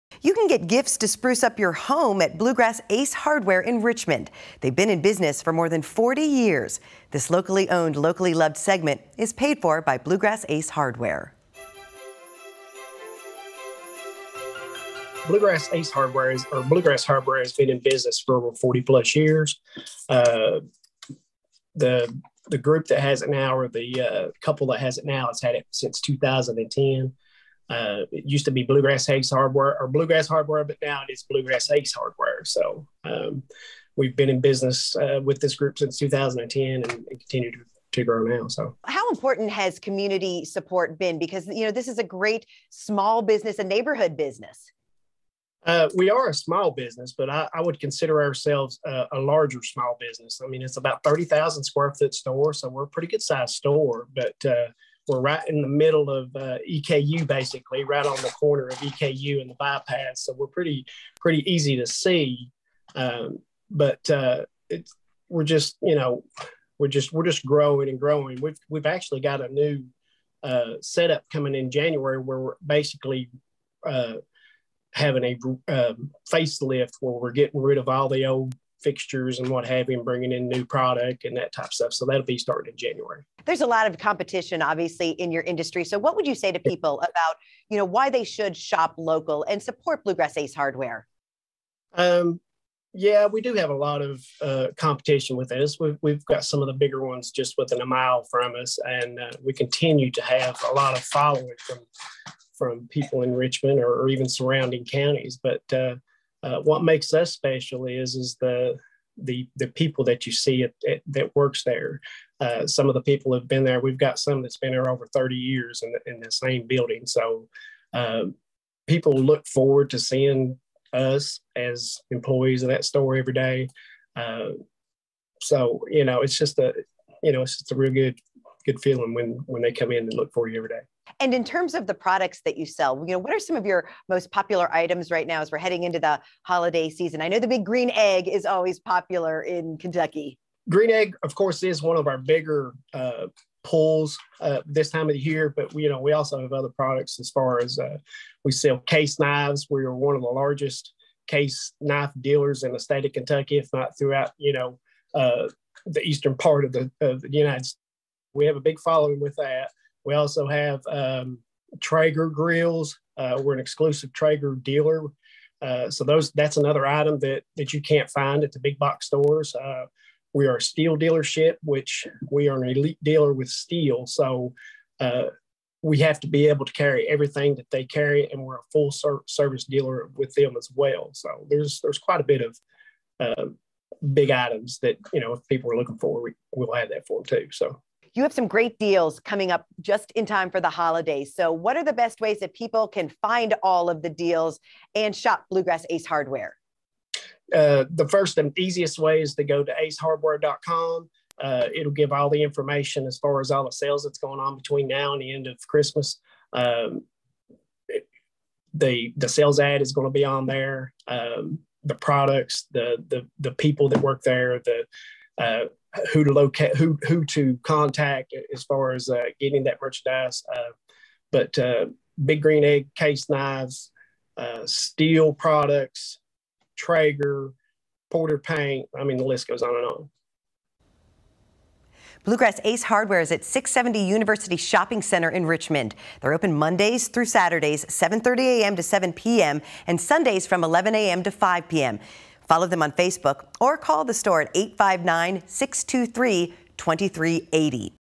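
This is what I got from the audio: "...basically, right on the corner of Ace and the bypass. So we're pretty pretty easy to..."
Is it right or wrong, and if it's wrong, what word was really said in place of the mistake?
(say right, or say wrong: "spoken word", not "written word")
wrong: "EKU", not "Ace".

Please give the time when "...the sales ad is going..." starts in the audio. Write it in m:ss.
3:29.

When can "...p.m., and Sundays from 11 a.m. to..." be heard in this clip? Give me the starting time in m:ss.
3:59.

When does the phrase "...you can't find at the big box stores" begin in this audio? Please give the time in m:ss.
2:47.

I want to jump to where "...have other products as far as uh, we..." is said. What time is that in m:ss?
2:26.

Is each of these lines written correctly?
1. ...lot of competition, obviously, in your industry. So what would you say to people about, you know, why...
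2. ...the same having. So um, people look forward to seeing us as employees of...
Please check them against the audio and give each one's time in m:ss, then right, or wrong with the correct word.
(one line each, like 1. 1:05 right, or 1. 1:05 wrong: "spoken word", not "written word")
1. 1:23 right
2. 1:56 wrong: "building", not "having".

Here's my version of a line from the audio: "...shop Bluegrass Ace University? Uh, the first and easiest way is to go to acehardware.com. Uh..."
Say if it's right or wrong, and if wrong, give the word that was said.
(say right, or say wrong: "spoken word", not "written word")
wrong: "Hardware", not "University".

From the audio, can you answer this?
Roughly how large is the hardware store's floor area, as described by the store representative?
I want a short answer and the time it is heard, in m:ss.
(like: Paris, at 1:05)
30,000 square feet, at 0:51.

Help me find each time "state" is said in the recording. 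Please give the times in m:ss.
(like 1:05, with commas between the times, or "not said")
2:32, 2:37.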